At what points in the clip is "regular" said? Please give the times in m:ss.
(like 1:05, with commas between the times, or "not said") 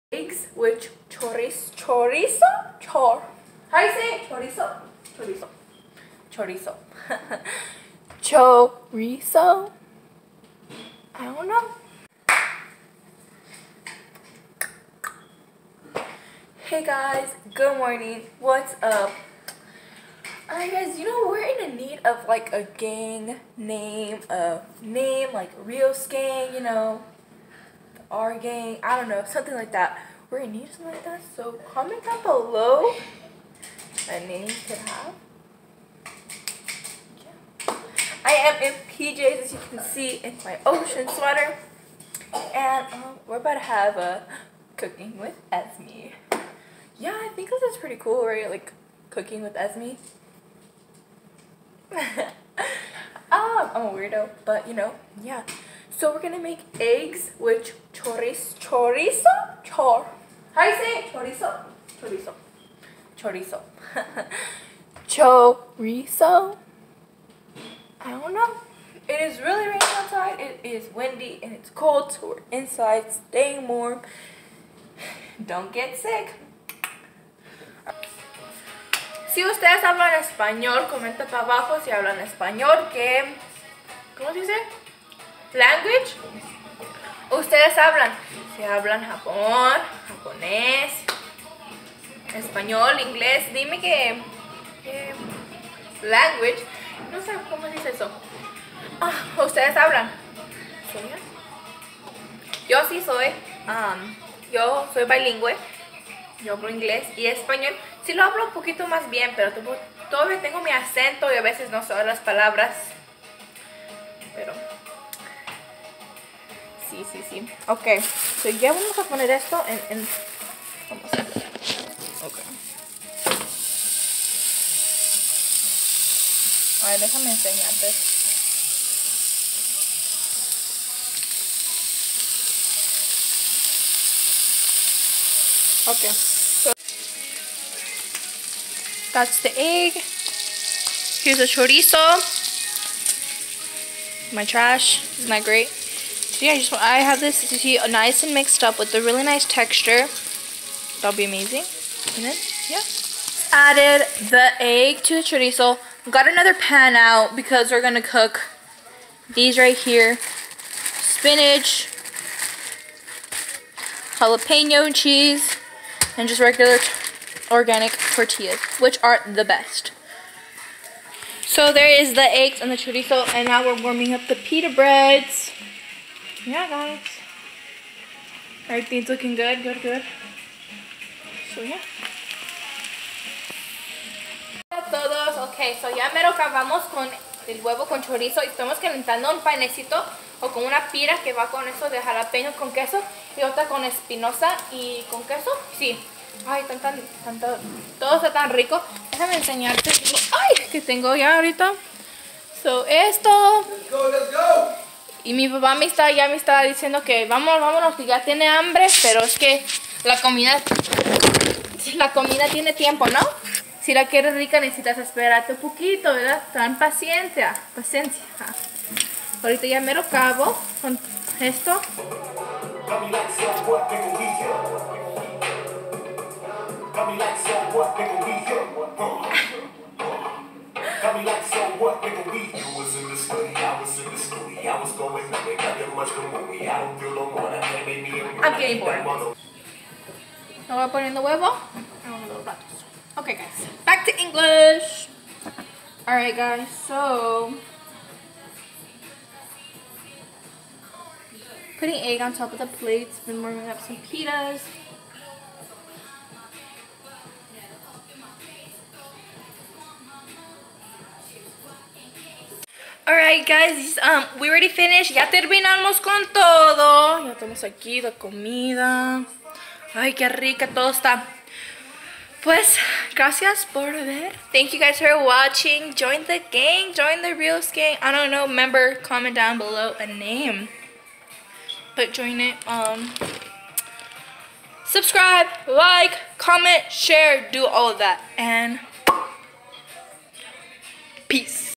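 2:46.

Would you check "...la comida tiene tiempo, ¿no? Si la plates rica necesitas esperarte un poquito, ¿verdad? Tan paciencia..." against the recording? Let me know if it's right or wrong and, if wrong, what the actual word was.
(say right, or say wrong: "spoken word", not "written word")
wrong: "quieres", not "plates".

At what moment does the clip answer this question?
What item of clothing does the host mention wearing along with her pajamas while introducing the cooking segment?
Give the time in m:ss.
0:40.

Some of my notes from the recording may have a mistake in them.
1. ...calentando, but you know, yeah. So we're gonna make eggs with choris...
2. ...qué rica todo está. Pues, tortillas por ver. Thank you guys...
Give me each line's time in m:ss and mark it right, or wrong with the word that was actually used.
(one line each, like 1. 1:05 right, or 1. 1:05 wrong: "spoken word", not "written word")
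1. 0:53 wrong: "weirdo", not "calentando"
2. 4:30 wrong: "gracias", not "tortillas".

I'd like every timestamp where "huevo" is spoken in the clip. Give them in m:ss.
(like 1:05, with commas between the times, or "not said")
3:07, 4:01.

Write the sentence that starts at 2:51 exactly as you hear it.
So there is the eggs and the chorizo, and now we're warming up the pita breads.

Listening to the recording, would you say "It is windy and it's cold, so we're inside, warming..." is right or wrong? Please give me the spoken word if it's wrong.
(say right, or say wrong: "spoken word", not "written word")
wrong: "staying", not "warming".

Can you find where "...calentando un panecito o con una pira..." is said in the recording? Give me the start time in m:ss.
3:08.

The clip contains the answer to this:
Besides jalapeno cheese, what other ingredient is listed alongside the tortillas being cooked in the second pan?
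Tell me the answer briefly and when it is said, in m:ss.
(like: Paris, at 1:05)
spinach, at 2:41.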